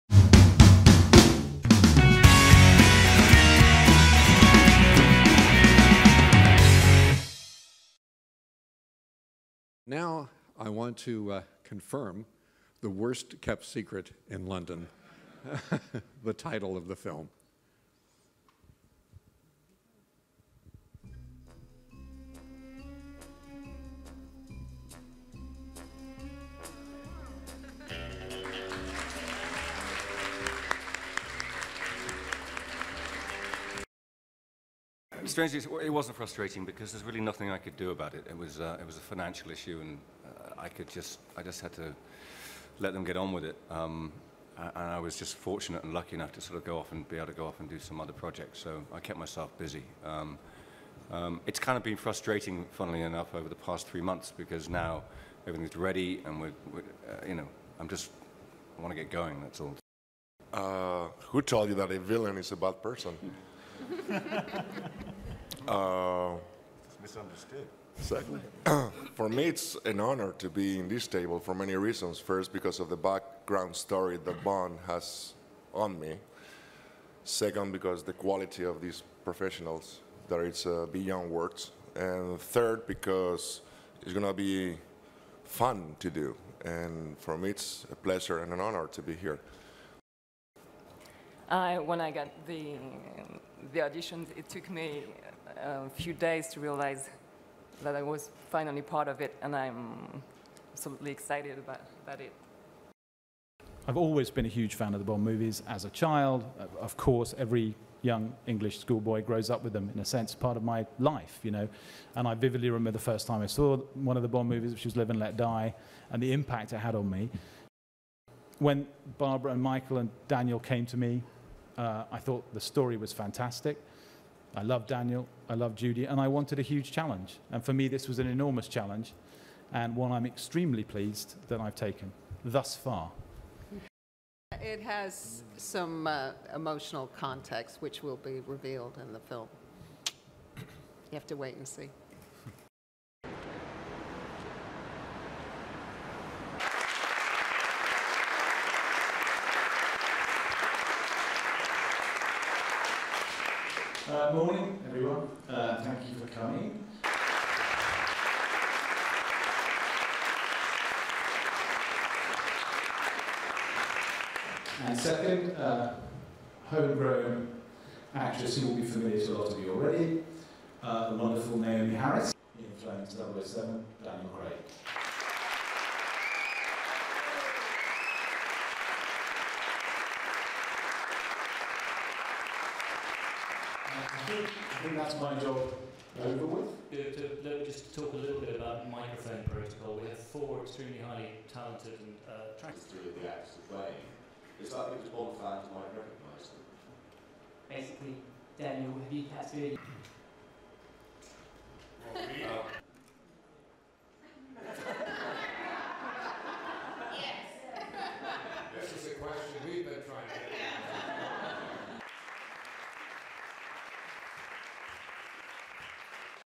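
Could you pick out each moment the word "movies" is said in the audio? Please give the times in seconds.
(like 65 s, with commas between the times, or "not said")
105 s, 114 s.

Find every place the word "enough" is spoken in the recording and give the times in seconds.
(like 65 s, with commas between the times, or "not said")
46 s, 53 s.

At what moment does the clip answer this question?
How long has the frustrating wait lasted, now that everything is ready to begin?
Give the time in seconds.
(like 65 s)
53 s.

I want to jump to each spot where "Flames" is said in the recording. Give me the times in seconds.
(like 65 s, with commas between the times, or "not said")
172 s.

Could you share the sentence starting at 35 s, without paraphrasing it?
strangely, it wasn't frustrating because there's really nothing I could do about it.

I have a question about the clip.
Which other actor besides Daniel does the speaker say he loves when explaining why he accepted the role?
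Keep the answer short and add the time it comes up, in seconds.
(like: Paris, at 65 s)
Judi, at 125 s.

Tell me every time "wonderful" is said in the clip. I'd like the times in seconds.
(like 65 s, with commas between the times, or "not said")
171 s.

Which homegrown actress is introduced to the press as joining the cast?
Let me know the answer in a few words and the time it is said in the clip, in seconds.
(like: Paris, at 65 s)
Naomie Harris, at 171 s.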